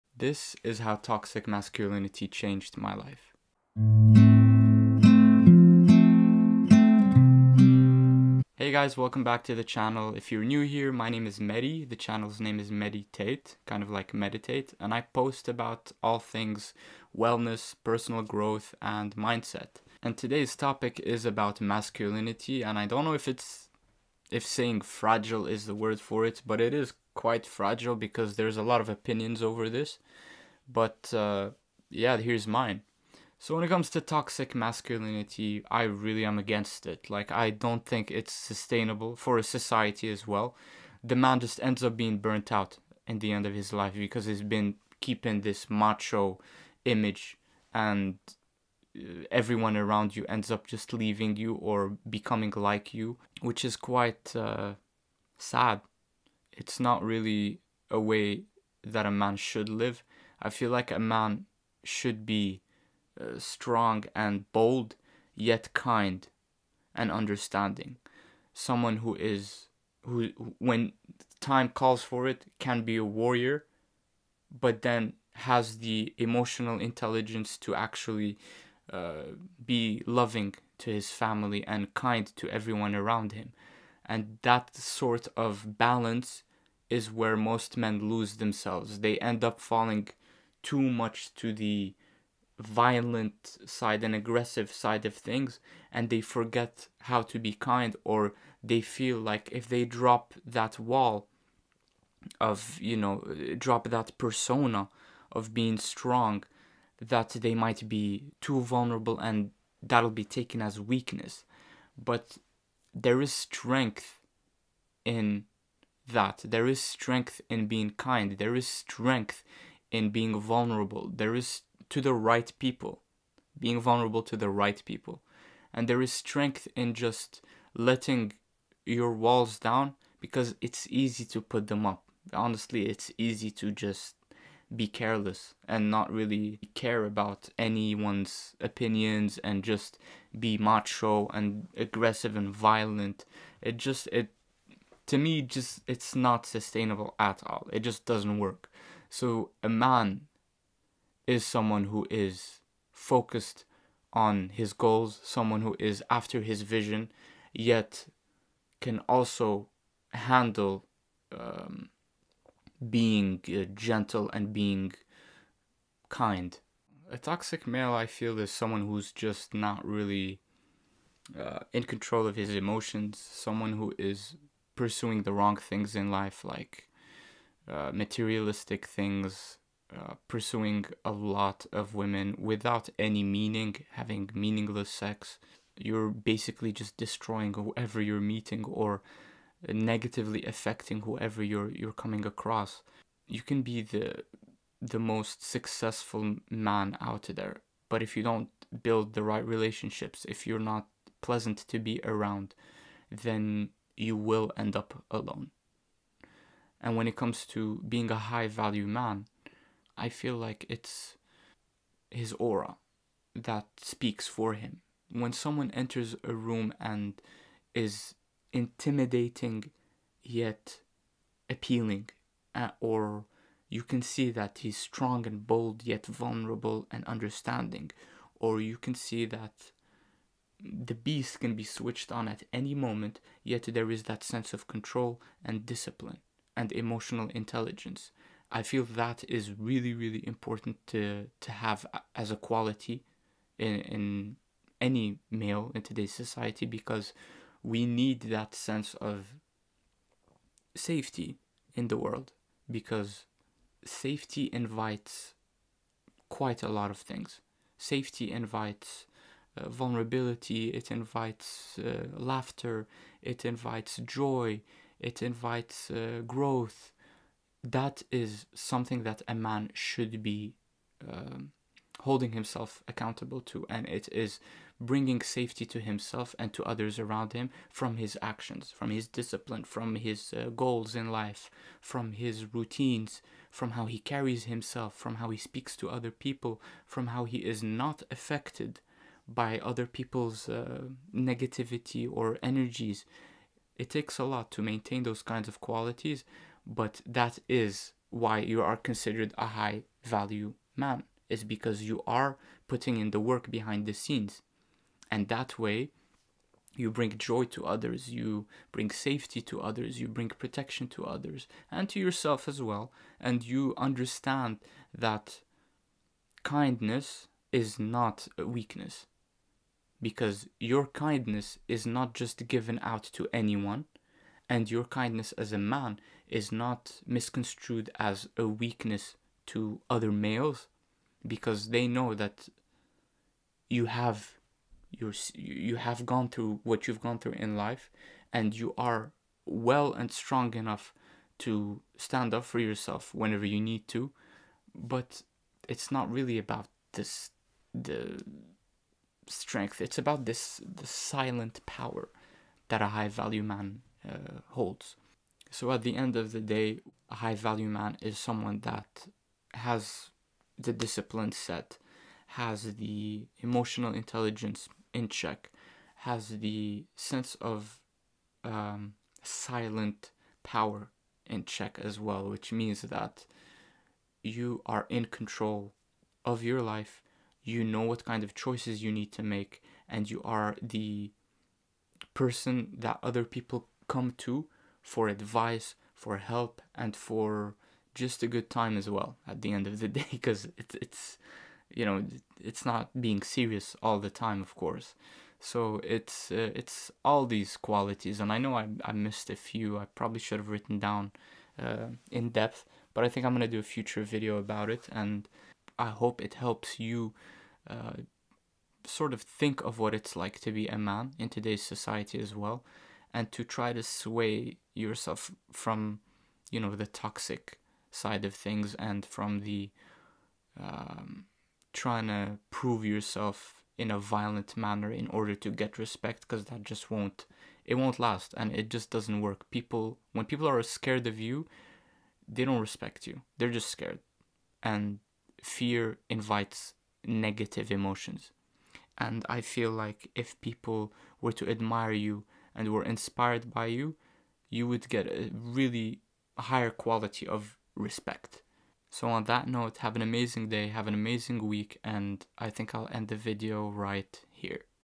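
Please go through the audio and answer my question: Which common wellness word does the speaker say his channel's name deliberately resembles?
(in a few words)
meditate.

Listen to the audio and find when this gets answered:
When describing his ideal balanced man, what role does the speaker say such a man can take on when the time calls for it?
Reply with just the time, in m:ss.
1:13.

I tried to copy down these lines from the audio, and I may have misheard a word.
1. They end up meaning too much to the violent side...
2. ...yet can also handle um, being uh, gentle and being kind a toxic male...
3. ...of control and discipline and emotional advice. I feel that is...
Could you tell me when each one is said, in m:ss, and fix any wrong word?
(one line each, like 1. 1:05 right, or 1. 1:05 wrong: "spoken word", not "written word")
1. 1:28 wrong: "falling", not "meaning"
2. 2:37 right
3. 3:54 wrong: "intelligence", not "advice".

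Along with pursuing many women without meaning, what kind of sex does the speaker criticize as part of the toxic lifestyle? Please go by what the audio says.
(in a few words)
meaningless sex.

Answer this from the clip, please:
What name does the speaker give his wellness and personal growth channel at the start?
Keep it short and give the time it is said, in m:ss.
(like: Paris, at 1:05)
Mehdi Tate, at 0:12.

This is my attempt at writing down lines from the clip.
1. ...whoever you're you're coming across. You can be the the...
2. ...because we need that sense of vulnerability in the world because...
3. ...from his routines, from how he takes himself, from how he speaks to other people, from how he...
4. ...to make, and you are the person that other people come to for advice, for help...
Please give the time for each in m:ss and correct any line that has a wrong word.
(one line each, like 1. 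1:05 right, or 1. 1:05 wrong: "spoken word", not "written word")
1. 3:11 right
2. 4:06 wrong: "safety", not "vulnerability"
3. 4:41 wrong: "carries", not "takes"
4. 6:19 right.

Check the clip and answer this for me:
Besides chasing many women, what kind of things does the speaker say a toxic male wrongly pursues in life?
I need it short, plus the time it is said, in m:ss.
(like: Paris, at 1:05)
materialistic things, at 2:57.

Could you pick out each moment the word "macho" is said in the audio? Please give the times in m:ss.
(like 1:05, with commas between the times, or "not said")
0:45, 2:20.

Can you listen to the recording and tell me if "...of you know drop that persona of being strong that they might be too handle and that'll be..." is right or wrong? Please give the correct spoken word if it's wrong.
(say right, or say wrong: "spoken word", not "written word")
wrong: "vulnerable", not "handle".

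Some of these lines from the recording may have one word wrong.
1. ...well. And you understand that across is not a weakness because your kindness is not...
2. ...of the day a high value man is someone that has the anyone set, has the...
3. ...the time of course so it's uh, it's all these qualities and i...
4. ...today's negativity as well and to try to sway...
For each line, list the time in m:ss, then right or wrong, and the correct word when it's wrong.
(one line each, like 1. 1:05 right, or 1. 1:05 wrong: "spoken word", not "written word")
1. 5:12 wrong: "kindness", not "across"
2. 5:56 wrong: "discipline", not "anyone"
3. 6:33 right
4. 6:51 wrong: "society", not "negativity".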